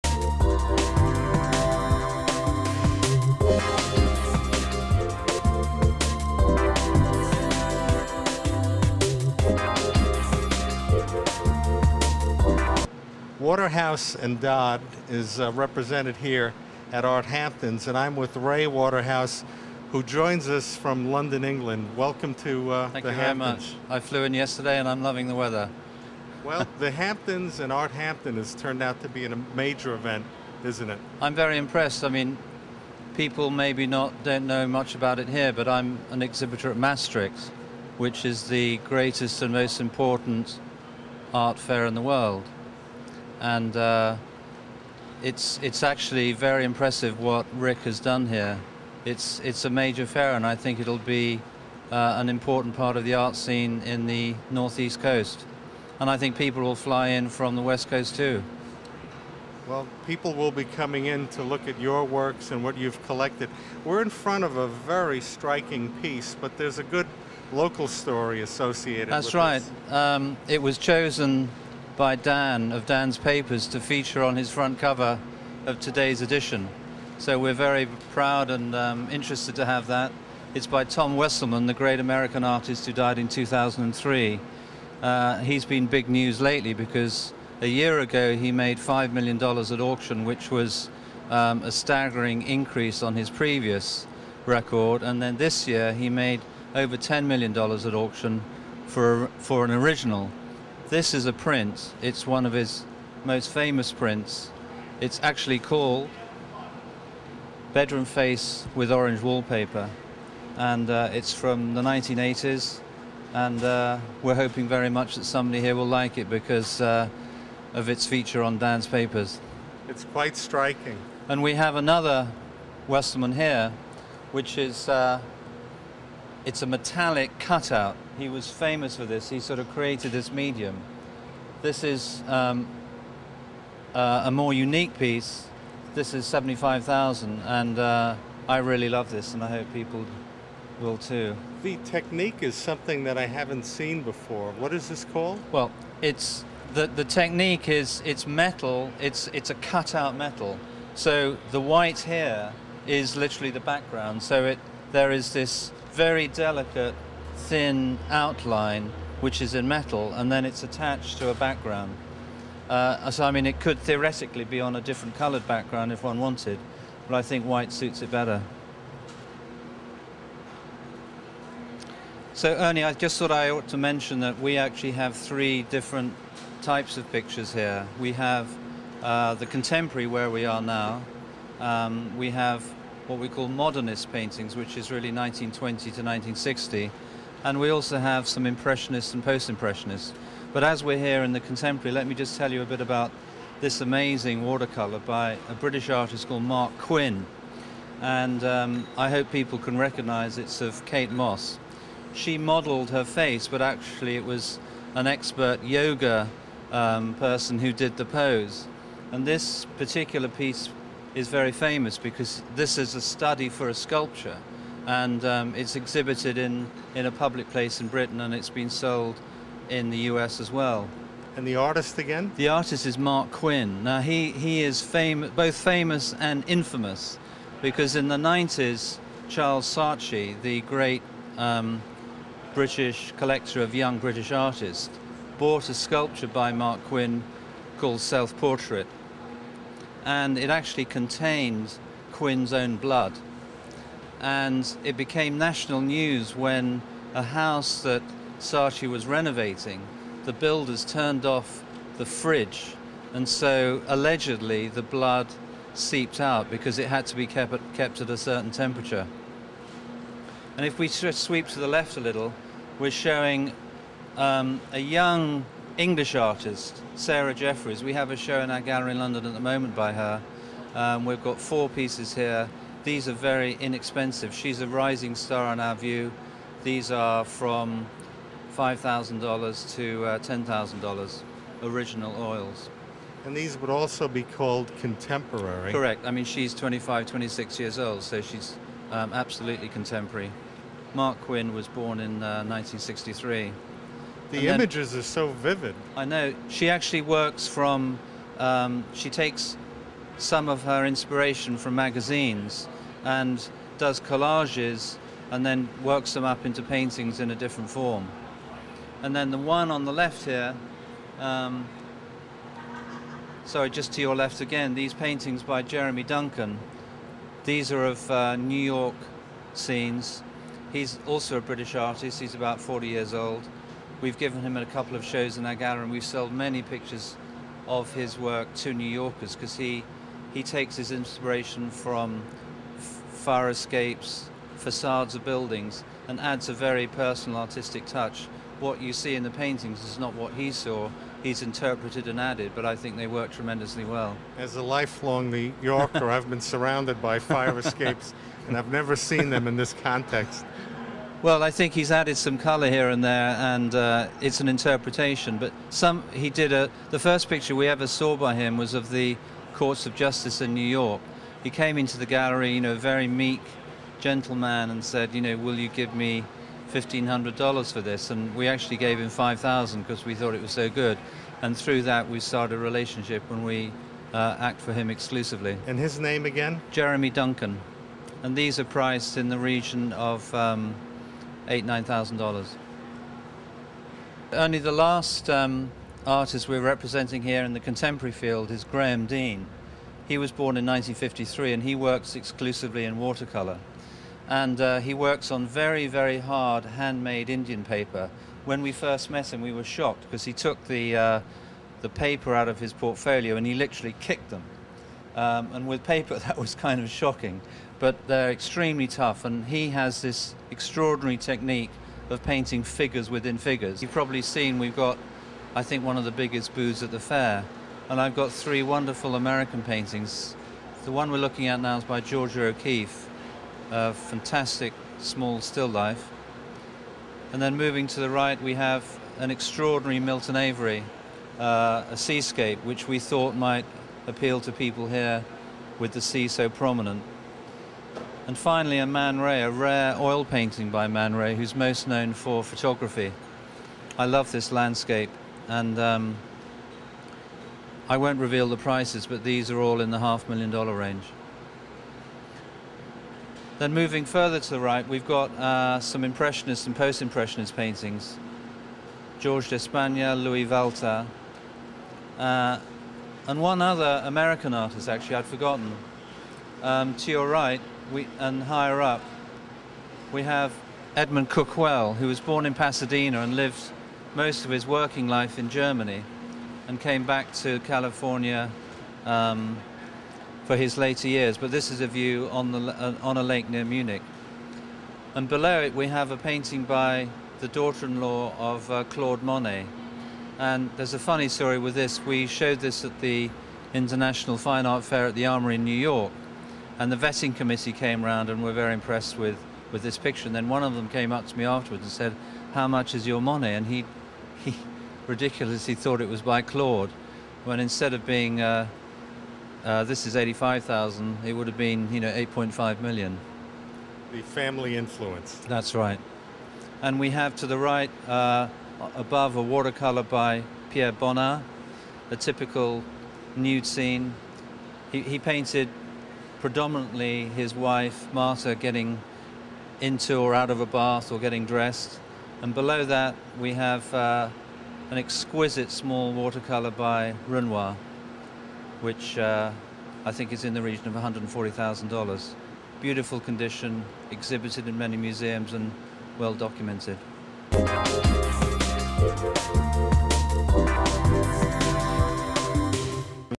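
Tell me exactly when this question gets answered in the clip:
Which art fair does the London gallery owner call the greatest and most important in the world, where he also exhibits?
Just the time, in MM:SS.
00:36.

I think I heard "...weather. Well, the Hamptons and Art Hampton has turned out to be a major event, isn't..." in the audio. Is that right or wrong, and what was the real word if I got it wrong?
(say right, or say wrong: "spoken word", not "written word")
right.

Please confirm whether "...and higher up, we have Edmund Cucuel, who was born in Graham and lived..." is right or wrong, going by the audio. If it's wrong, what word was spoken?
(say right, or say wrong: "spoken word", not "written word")
wrong: "Pasadena", not "Graham".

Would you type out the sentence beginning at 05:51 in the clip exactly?
Well, I think he's added some colour here and there, and uh, it's an interpretation.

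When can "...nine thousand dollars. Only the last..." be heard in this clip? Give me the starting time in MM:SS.
06:21.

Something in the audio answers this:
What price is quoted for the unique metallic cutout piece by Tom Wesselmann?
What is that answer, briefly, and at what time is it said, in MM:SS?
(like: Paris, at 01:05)
75,000, at 02:16.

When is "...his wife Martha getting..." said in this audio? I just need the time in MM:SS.
08:47.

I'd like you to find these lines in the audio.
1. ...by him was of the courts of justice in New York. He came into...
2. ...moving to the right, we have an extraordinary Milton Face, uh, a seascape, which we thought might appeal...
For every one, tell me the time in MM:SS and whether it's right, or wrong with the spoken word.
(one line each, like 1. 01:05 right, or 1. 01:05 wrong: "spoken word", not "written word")
1. 05:58 right
2. 07:07 wrong: "Avery", not "Face".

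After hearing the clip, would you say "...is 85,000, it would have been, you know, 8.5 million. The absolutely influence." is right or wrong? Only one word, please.
wrong.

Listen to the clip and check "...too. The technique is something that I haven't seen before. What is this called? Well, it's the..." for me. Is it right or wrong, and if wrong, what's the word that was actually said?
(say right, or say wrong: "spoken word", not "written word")
right.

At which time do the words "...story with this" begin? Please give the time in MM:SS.
08:11.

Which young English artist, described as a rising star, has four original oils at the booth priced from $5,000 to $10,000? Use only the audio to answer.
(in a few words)
Sarah Jeffries.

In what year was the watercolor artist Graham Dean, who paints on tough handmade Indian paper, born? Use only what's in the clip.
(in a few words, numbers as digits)
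1953.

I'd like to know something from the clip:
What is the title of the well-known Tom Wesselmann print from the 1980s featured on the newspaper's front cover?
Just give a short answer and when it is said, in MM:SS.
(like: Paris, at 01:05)
Bedroom Face with Orange Wallpaper, at 01:47.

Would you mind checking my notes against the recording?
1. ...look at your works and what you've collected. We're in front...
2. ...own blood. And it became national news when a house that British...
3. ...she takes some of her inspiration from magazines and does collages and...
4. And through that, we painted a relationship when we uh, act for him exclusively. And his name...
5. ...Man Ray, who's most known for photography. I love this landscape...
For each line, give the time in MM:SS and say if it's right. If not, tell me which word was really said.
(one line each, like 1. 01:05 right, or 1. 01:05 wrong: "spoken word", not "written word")
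1. 01:01 right
2. 04:02 wrong: "Saatchi", not "British"
3. 04:58 right
4. 06:11 wrong: "started", not "painted"
5. 07:20 right.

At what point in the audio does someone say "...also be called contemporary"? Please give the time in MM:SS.
04:43.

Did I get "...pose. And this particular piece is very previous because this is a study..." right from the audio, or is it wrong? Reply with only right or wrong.
wrong.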